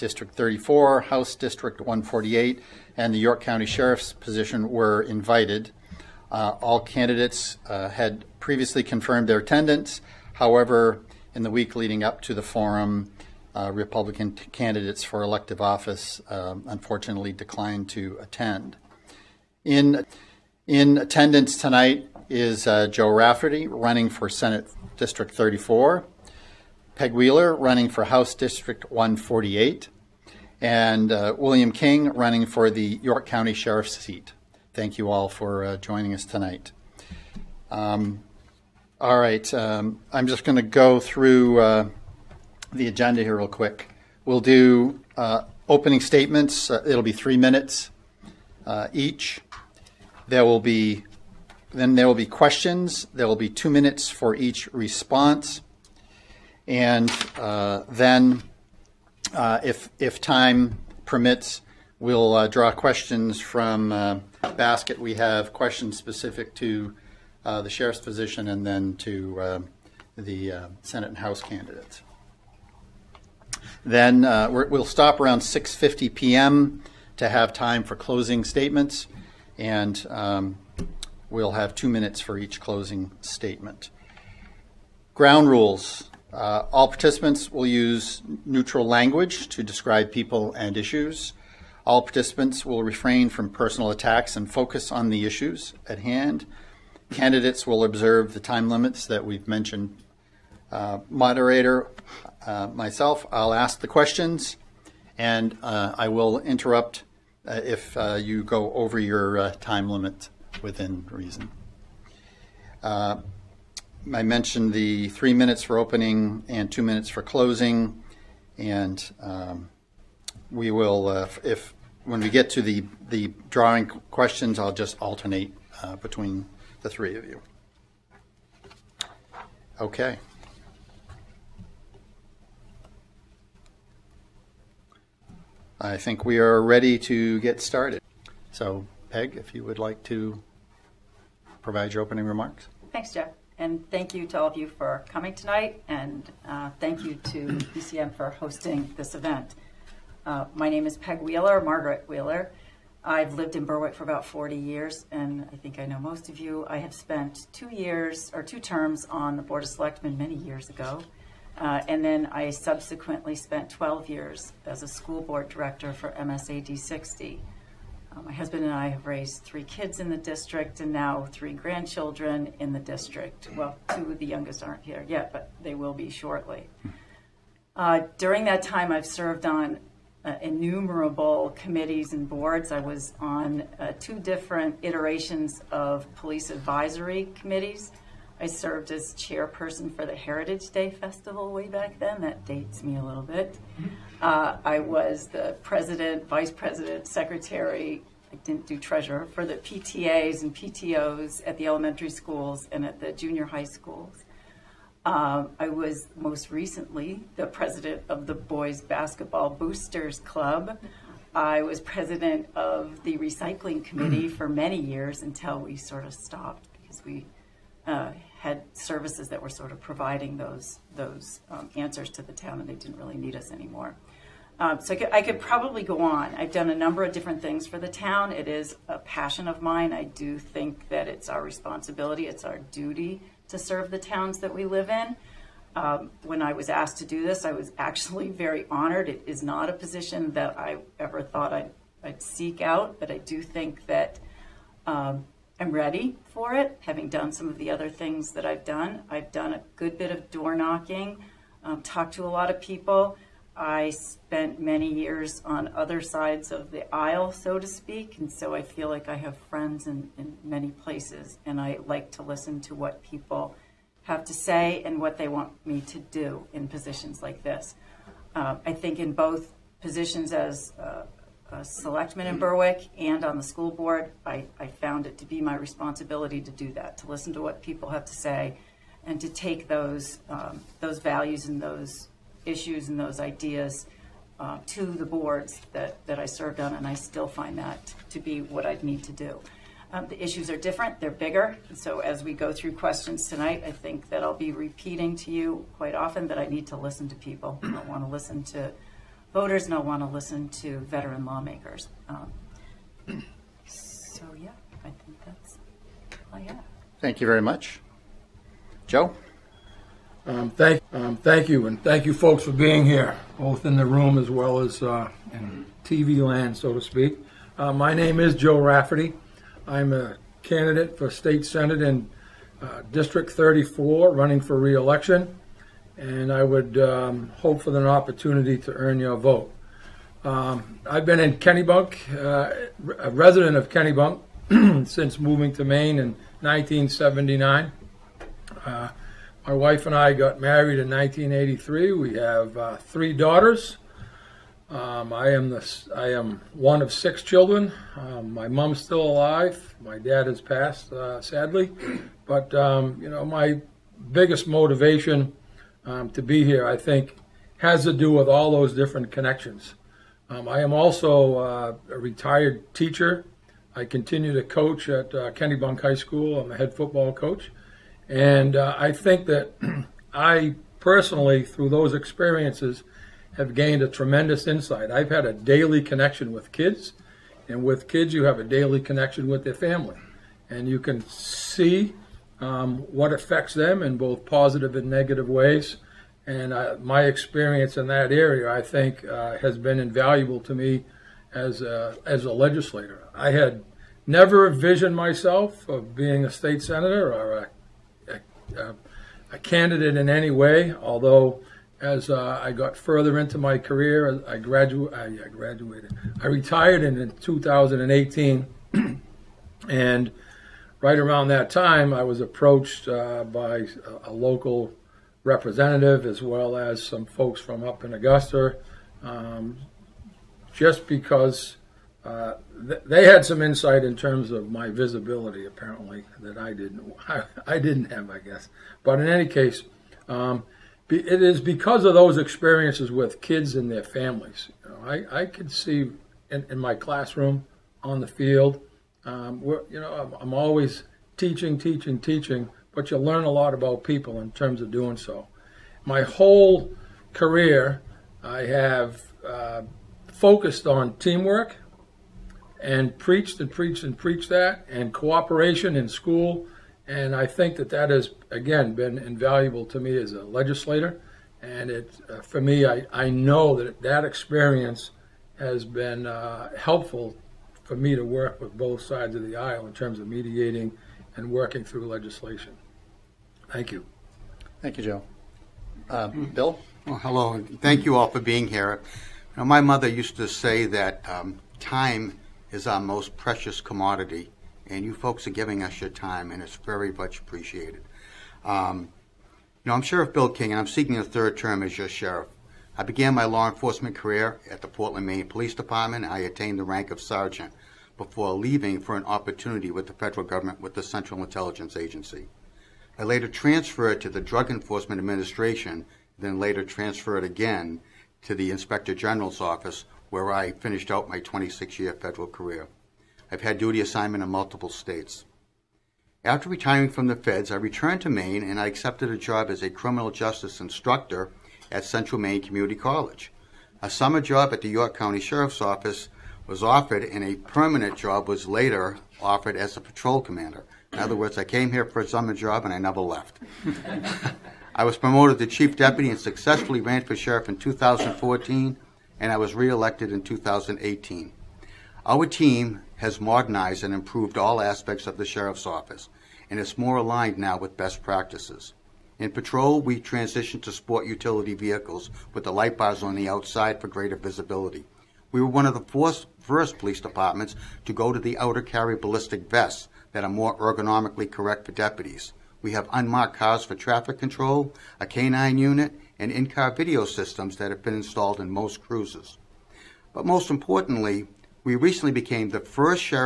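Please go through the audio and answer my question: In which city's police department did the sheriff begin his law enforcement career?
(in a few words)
Portland.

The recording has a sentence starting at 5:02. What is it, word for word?
Um, so yeah, I think that's all I have.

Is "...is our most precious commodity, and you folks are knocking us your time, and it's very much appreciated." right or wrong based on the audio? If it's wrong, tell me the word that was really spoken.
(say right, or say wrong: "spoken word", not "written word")
wrong: "giving", not "knocking".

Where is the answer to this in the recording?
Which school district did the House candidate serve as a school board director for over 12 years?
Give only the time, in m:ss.
2:46.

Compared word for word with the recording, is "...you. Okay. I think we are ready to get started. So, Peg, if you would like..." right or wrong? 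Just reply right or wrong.
right.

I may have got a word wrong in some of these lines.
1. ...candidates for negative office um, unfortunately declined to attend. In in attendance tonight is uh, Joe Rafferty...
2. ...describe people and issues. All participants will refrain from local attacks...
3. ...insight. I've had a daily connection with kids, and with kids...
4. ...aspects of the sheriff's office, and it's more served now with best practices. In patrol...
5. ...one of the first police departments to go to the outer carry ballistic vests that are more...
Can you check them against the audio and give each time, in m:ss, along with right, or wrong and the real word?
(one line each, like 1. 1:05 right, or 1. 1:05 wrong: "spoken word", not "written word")
1. 0:14 wrong: "elective", not "negative"
2. 1:29 wrong: "personal", not "local"
3. 6:14 right
4. 9:04 wrong: "aligned", not "served"
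5. 9:15 right.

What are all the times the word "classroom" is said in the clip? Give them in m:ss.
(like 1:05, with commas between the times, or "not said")
7:16.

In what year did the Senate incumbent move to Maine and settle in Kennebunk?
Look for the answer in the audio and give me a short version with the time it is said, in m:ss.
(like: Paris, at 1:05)
1979, at 5:36.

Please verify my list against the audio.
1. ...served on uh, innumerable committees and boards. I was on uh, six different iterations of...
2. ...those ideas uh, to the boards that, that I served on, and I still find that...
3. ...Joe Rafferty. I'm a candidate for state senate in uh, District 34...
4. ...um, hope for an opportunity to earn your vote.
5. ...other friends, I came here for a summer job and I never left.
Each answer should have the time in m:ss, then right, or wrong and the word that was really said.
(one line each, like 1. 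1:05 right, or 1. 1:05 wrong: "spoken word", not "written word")
1. 2:59 wrong: "two", not "six"
2. 4:42 right
3. 5:18 right
4. 5:26 right
5. 8:50 wrong: "words", not "friends".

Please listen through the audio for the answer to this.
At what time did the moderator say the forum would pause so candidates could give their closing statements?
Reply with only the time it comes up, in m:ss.
1:15.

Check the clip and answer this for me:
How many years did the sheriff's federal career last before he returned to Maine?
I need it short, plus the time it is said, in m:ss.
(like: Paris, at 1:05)
26, at 8:31.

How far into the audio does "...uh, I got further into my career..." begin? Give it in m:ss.
6:42.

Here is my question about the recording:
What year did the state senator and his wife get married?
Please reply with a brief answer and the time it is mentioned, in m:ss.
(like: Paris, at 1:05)
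1983, at 5:40.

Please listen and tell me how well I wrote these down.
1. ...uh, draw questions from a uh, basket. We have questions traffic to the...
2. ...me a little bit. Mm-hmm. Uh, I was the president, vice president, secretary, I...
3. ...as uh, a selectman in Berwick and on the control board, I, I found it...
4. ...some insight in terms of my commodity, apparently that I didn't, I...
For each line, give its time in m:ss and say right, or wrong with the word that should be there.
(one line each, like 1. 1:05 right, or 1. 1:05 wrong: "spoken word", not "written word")
1. 1:02 wrong: "specific", not "traffic"
2. 3:12 right
3. 4:30 wrong: "school", not "control"
4. 7:03 wrong: "visibility", not "commodity".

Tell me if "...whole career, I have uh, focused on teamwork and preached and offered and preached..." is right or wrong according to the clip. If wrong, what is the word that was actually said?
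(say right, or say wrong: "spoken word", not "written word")
wrong: "preached", not "offered".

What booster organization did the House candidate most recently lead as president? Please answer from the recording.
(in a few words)
Boys Basketball Boosters Club.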